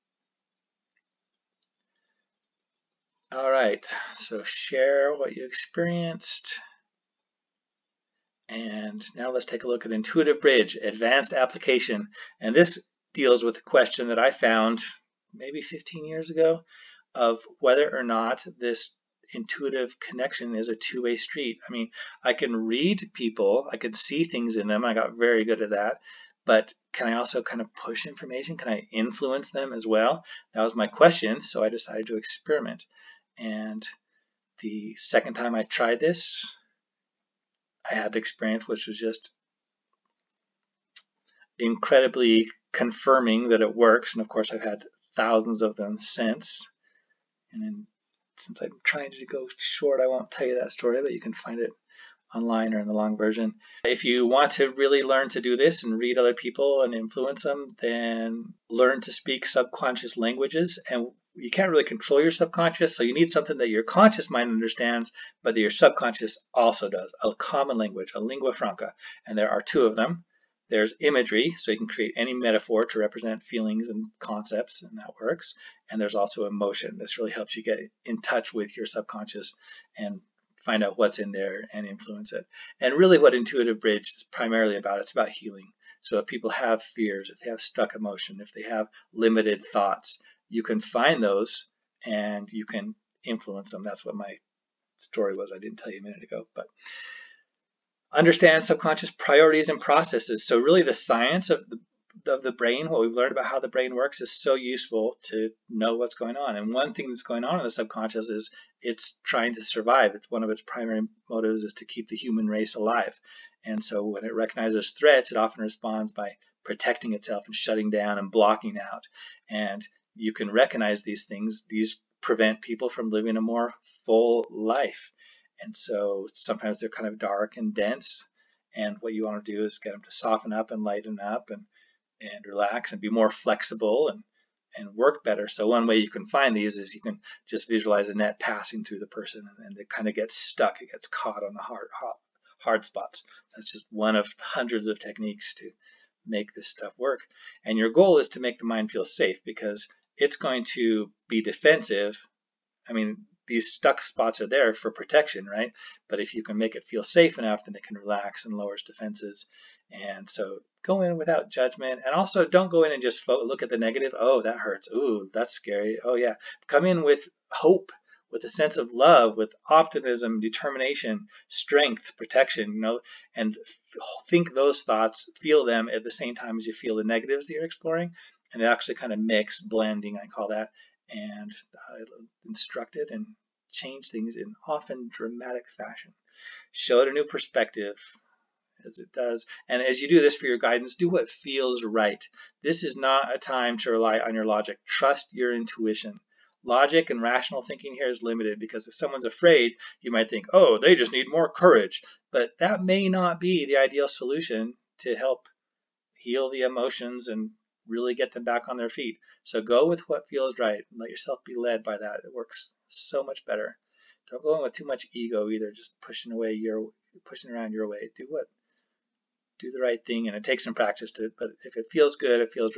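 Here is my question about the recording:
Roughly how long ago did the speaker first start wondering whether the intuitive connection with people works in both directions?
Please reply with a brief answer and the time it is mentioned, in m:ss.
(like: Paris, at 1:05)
15 years, at 0:15.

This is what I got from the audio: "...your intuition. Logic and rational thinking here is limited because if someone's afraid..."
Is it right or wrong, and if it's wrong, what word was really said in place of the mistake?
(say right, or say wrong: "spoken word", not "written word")
right.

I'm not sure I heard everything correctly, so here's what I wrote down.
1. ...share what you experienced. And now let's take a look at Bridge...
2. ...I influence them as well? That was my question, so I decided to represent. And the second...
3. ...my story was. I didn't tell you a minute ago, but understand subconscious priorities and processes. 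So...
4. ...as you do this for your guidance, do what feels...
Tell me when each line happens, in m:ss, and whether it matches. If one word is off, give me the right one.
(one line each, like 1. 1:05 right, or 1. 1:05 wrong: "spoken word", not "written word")
1. 0:04 wrong: "Intuitive", not "Bridge"
2. 0:28 wrong: "experiment", not "represent"
3. 1:34 right
4. 3:09 right.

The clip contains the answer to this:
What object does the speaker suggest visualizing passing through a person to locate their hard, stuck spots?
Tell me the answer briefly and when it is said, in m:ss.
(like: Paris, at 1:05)
a net, at 2:18.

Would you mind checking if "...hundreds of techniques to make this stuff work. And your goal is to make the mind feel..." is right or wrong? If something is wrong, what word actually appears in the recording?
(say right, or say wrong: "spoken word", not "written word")
right.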